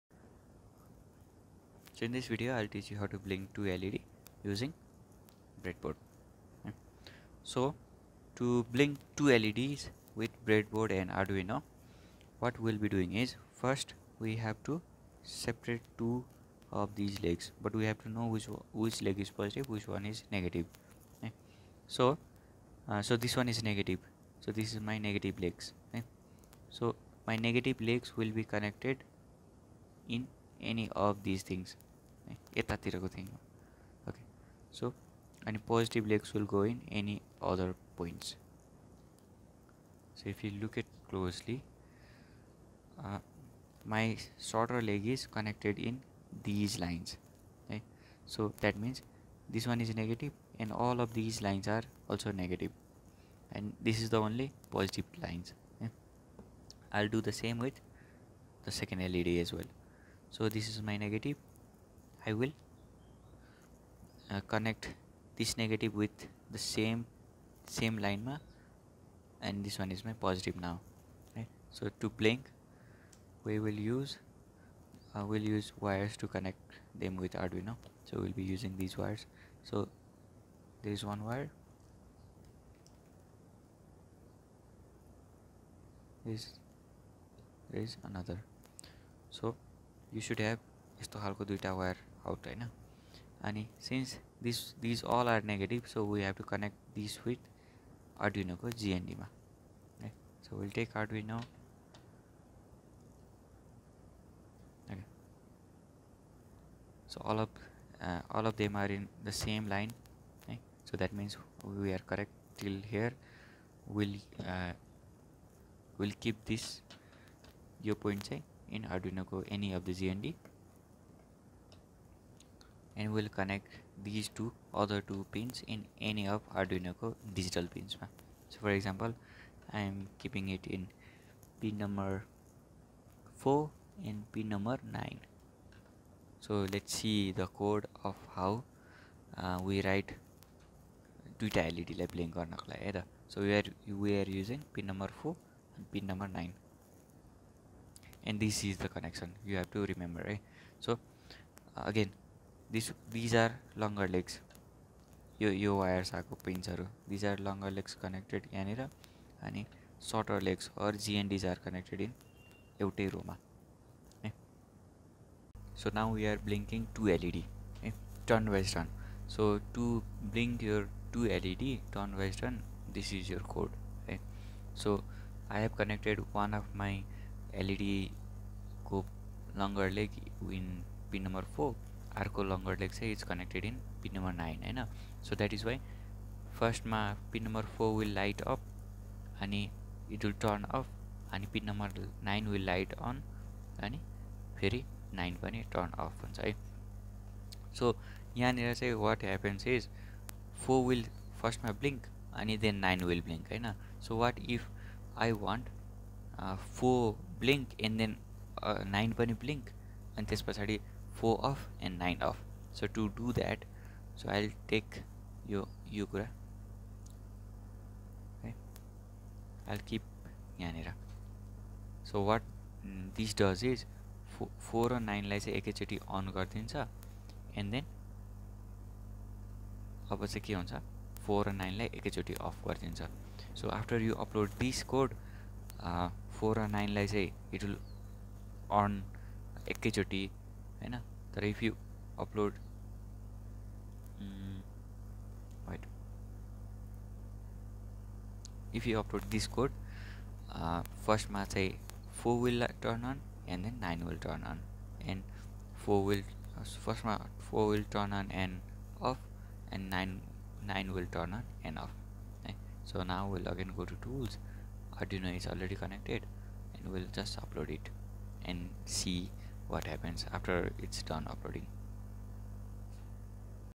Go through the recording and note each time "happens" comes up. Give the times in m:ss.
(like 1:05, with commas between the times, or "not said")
4:29.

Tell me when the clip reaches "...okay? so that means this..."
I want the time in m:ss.
0:47.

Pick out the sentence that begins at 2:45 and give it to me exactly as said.
so now we are blinking two led okay.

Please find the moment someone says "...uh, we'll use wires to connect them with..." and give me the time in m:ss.
1:15.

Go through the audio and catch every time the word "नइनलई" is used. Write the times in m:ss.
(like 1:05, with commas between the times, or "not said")
3:44, 3:51, 3:56.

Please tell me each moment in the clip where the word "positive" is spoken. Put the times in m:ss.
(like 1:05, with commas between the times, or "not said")
0:19, 0:54, 1:10.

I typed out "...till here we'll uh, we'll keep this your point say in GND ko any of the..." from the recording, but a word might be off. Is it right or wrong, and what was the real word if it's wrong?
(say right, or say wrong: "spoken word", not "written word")
wrong: "Arduino", not "GND".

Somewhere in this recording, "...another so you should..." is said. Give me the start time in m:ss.
1:28.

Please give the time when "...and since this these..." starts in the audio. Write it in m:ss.
1:33.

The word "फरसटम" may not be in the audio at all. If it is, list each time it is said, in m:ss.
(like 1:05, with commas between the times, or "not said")
3:06, 3:21.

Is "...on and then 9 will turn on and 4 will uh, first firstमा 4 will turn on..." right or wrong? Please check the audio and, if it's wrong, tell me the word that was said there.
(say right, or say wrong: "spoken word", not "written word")
right.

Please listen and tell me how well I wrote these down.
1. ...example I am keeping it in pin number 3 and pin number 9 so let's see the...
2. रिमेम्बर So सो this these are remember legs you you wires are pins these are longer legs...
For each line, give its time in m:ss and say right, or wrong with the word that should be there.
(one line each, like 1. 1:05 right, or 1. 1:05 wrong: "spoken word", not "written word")
1. 2:08 wrong: "4", not "3"
2. 2:30 wrong: "longer", not "remember".